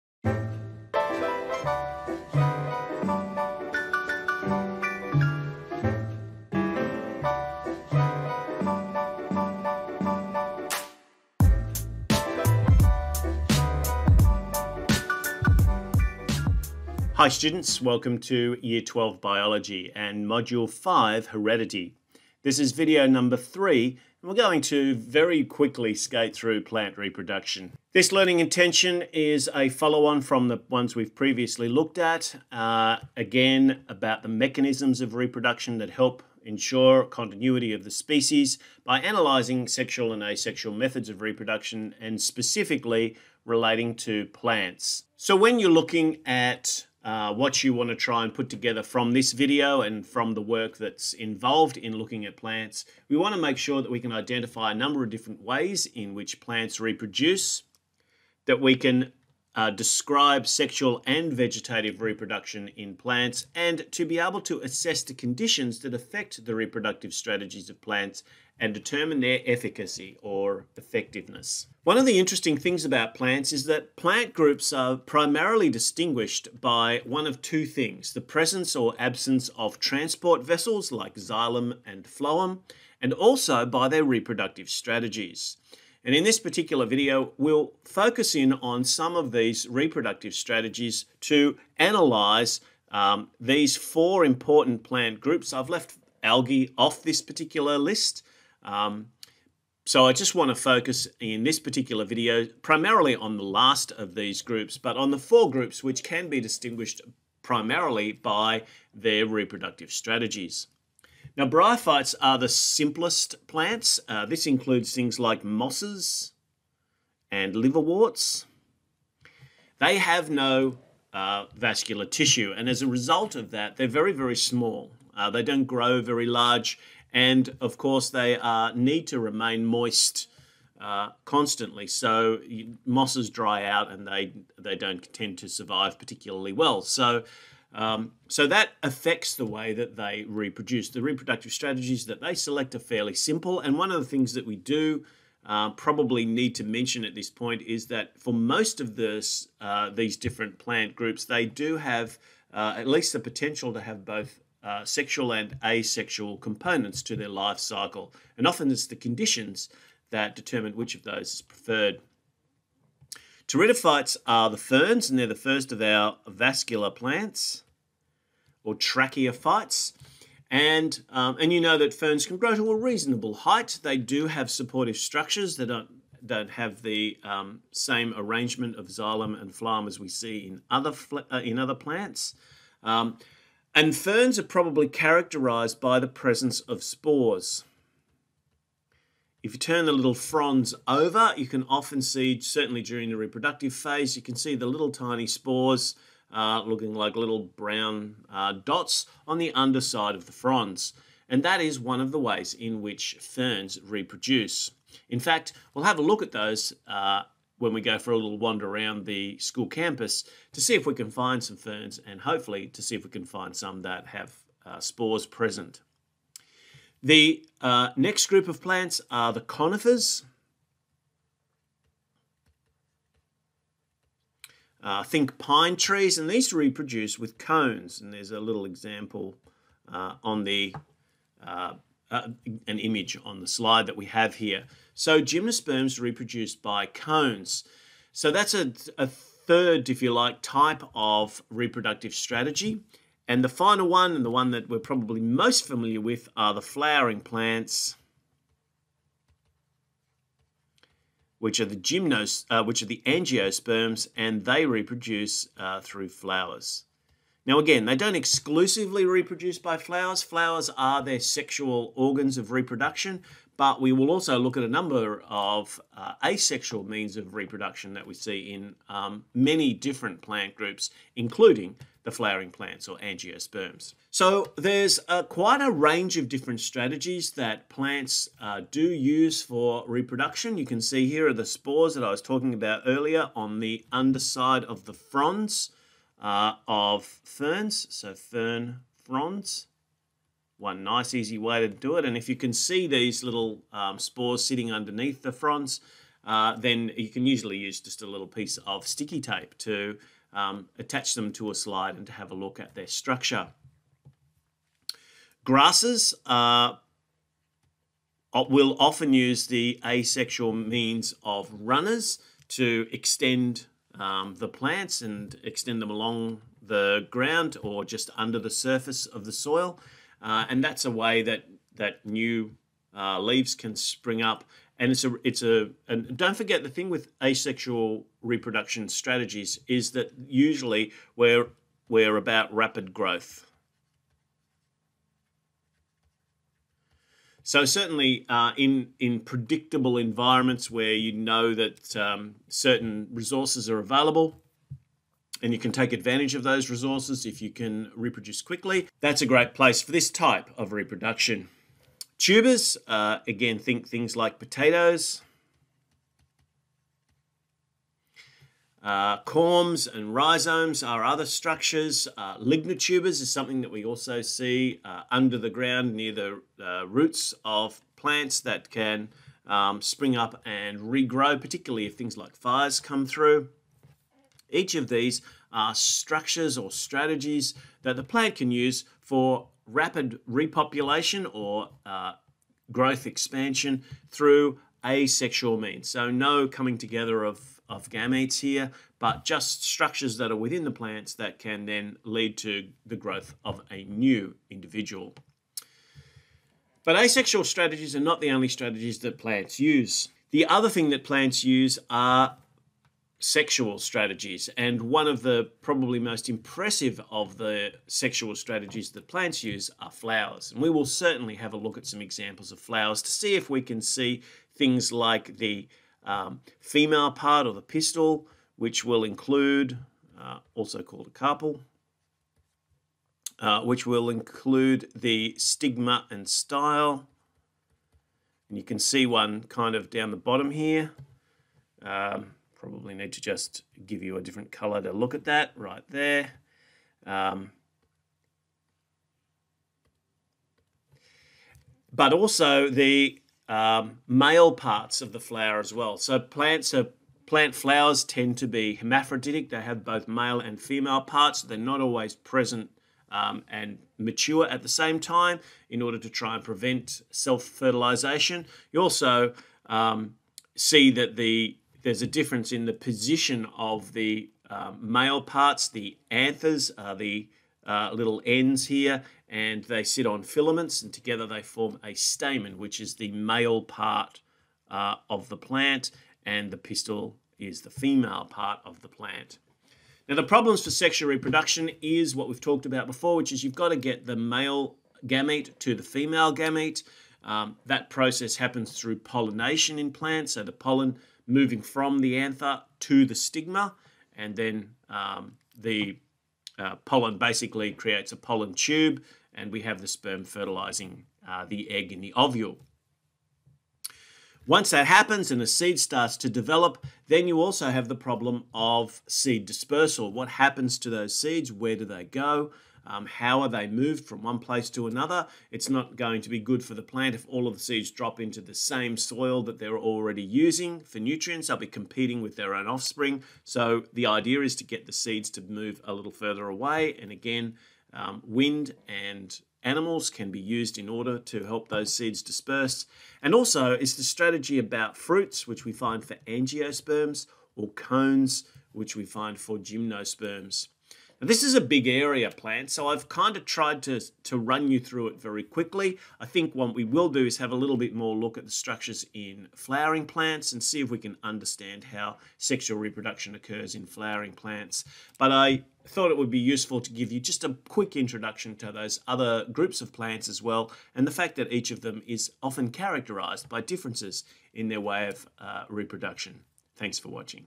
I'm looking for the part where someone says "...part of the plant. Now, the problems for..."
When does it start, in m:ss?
7:58.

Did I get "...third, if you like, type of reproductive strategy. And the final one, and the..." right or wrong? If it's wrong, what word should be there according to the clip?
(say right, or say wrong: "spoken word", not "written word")
right.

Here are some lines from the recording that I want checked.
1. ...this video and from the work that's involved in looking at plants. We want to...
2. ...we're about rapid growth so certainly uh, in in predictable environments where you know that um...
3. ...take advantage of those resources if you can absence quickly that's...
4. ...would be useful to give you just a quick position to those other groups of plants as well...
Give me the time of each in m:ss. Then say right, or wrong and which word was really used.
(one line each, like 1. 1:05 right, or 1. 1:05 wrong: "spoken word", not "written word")
1. 0:49 right
2. 5:31 right
3. 5:45 wrong: "reproduce", not "absence"
4. 9:16 wrong: "introduction", not "position".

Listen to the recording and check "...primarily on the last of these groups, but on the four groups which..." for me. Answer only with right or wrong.
right.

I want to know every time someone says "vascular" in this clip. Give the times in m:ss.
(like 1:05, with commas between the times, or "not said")
2:01, 2:46.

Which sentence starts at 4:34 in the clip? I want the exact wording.
So there's uh, quite a range of different strategies that plants uh, do use for reproduction.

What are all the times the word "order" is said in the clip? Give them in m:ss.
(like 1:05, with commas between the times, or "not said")
7:35, 8:50.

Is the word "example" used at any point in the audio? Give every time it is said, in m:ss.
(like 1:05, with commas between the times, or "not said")
3:48, 6:52.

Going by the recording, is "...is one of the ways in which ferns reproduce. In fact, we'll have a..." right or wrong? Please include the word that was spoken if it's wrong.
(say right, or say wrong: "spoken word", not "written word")
right.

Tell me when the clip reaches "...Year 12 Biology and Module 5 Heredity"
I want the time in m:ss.
0:18.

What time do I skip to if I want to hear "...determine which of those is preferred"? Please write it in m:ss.
2:40.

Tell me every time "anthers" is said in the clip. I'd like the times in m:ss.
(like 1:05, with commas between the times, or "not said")
7:46, 8:12.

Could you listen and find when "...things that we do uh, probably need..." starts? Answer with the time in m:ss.
2:24.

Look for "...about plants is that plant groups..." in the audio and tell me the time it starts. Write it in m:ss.
1:12.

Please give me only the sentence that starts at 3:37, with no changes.
The uh, next group of plants are the conifers.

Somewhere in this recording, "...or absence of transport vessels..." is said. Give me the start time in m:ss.
1:18.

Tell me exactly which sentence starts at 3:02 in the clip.
Um, and ferns are probably characterized by the presence of spores.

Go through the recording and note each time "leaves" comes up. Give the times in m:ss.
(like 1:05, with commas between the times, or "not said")
5:23.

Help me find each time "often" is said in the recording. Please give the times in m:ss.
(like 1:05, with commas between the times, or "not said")
2:38, 3:11, 5:08, 9:22.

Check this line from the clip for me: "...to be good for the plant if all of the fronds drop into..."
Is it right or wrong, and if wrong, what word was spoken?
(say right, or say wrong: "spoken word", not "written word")
wrong: "seeds", not "fronds".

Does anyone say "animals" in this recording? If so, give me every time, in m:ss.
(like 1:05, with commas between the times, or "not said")
8:49.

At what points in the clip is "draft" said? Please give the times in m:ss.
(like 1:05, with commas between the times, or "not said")
not said.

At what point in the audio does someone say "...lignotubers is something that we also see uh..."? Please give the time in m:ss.
6:02.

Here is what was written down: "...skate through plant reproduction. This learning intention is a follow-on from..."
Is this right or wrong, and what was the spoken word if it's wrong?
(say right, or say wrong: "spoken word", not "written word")
right.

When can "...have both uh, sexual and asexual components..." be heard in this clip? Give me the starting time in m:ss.
2:33.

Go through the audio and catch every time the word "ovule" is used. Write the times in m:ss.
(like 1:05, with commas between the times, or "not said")
8:22.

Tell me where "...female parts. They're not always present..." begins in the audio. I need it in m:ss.
7:30.